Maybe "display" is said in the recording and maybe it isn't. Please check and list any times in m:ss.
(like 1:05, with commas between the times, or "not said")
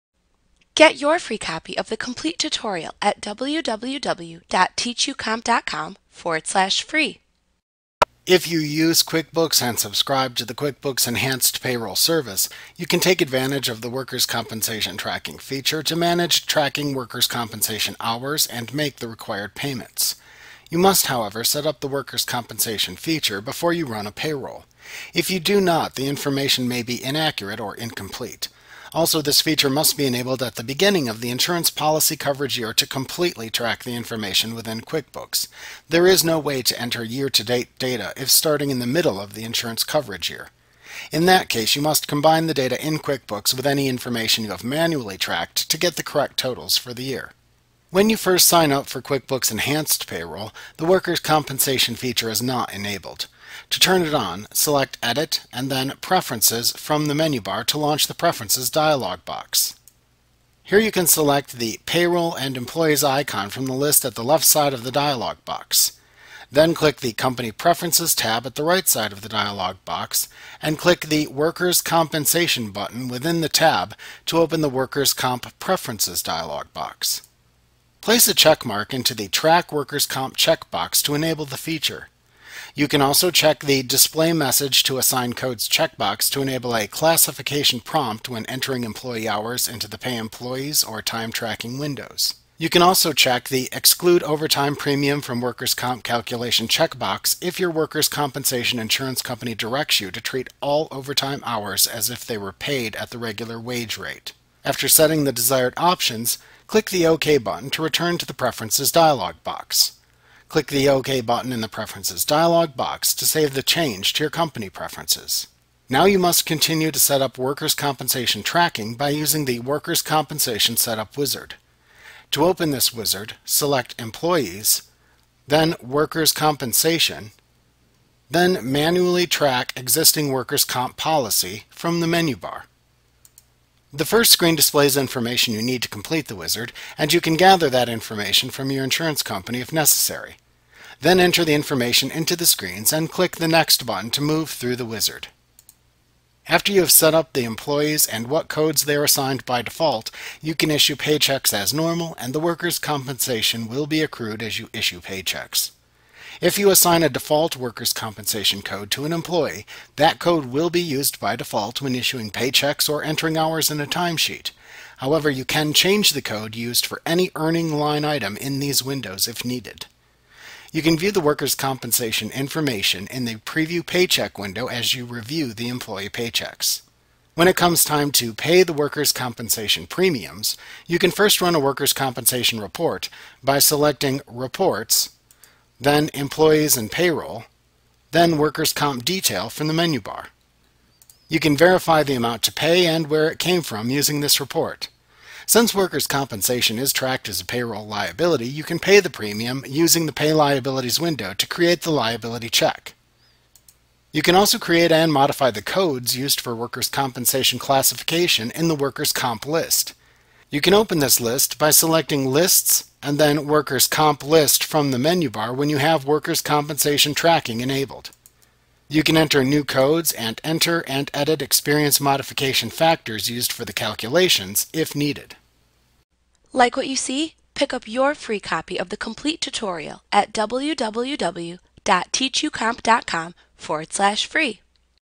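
1:23, 2:14.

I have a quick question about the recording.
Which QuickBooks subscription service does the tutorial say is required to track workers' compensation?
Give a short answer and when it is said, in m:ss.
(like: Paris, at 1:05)
Enhanced Payroll Service, at 0:10.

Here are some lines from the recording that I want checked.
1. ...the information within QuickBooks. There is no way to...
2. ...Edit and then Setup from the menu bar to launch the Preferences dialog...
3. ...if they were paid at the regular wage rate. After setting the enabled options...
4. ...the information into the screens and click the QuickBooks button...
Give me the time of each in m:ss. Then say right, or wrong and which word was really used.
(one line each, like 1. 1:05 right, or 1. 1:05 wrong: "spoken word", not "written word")
1. 0:33 right
2. 0:55 wrong: "Preferences", not "Setup"
3. 1:42 wrong: "desired", not "enabled"
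4. 2:21 wrong: "Next", not "QuickBooks".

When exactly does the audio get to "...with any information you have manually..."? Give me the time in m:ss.
0:43.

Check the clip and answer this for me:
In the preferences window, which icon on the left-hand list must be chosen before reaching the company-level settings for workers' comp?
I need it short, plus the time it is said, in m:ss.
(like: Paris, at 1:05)
Payroll and Employees, at 1:01.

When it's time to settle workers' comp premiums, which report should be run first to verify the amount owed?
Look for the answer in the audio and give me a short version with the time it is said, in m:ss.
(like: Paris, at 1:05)
Workers' Comp Detail, at 3:08.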